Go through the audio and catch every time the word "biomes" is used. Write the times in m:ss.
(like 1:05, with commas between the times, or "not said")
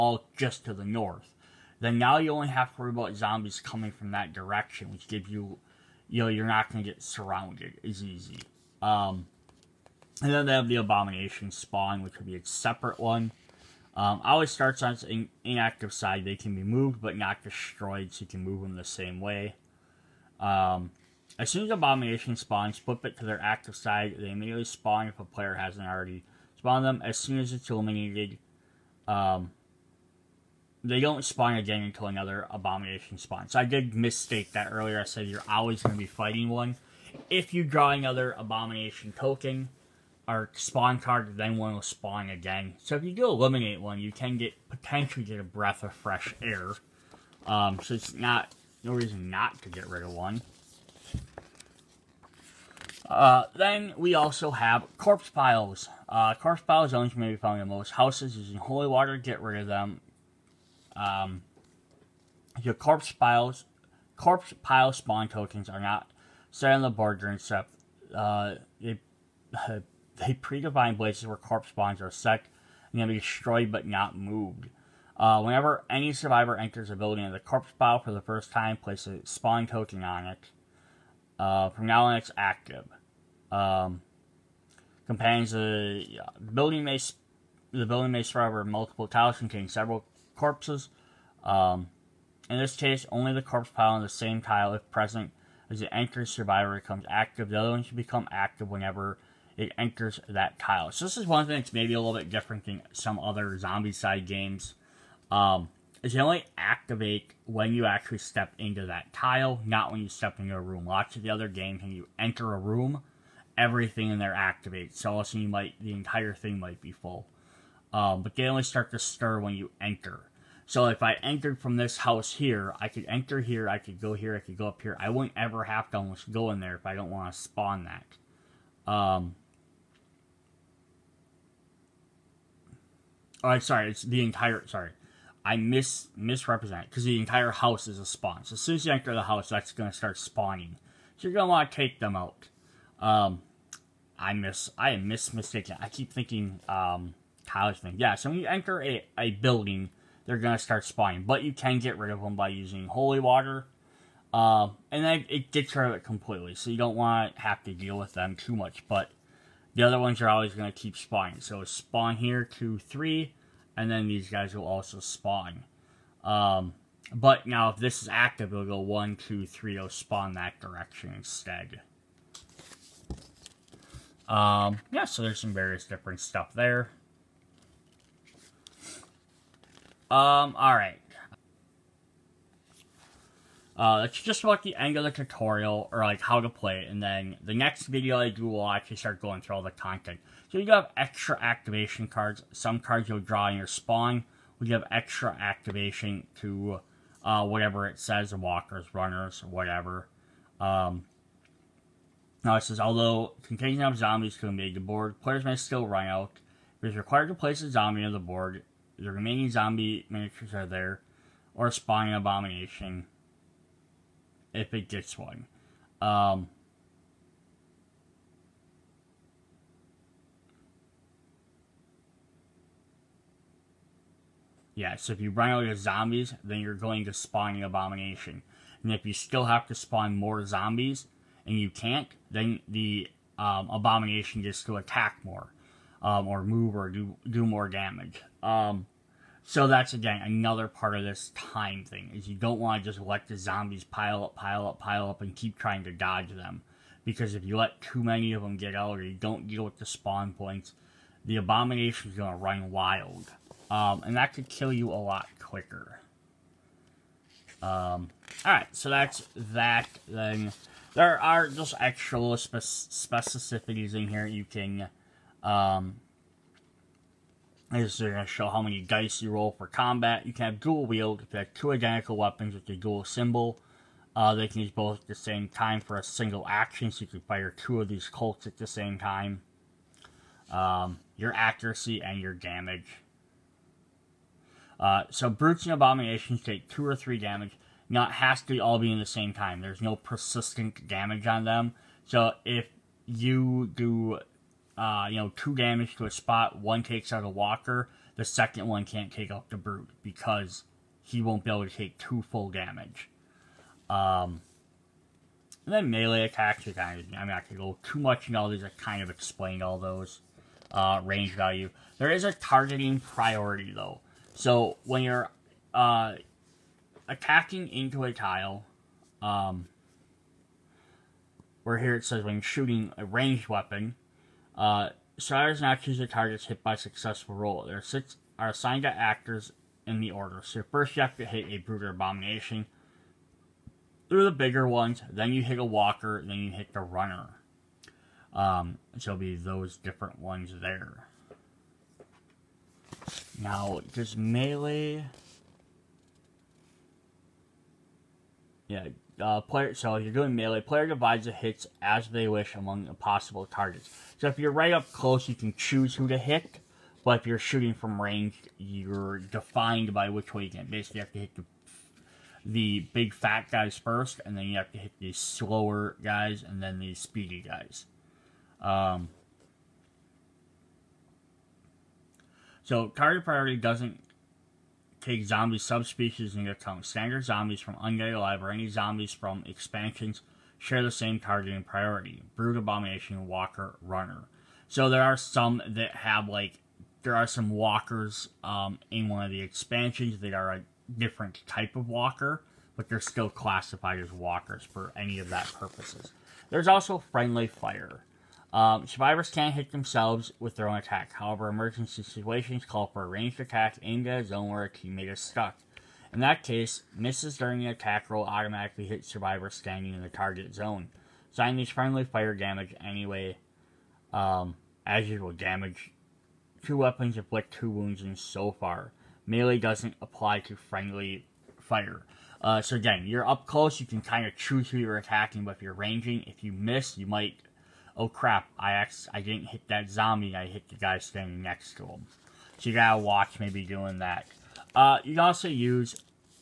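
not said.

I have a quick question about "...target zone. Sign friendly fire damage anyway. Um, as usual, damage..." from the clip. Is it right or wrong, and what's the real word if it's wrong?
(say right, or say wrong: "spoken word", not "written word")
right.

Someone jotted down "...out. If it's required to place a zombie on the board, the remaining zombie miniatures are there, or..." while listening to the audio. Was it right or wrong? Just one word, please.
right.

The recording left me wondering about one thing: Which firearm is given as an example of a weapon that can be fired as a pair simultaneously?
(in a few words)
Colts.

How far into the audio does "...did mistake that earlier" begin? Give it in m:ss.
0:33.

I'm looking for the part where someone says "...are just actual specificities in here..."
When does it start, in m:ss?
4:21.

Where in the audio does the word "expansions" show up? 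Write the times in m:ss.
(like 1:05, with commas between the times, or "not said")
6:19, 6:29.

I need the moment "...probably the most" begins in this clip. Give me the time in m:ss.
0:57.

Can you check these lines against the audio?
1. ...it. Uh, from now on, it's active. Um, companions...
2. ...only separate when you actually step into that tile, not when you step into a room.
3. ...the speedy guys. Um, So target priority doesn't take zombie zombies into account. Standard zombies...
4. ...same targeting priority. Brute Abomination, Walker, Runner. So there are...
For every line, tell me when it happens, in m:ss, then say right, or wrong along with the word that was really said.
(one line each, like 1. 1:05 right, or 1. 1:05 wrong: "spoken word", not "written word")
1. 1:20 right
2. 1:46 wrong: "activate", not "separate"
3. 6:06 wrong: "subspecies", not "zombies"
4. 6:20 right.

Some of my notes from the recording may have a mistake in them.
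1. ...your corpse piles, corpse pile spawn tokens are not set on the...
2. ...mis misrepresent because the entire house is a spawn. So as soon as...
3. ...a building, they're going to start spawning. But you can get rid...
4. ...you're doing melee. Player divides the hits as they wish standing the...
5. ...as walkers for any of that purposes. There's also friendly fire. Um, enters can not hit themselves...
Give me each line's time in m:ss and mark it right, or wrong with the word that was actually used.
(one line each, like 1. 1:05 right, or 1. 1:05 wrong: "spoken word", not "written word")
1. 1:02 right
2. 2:15 right
3. 2:29 right
4. 5:49 wrong: "among", not "standing"
5. 6:33 wrong: "survivors", not "enters".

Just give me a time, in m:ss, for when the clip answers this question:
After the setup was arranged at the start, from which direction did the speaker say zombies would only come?
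0:00.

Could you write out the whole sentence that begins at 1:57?
Um, but they only start to stir when you enter.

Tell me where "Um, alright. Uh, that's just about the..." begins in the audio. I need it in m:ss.
3:00.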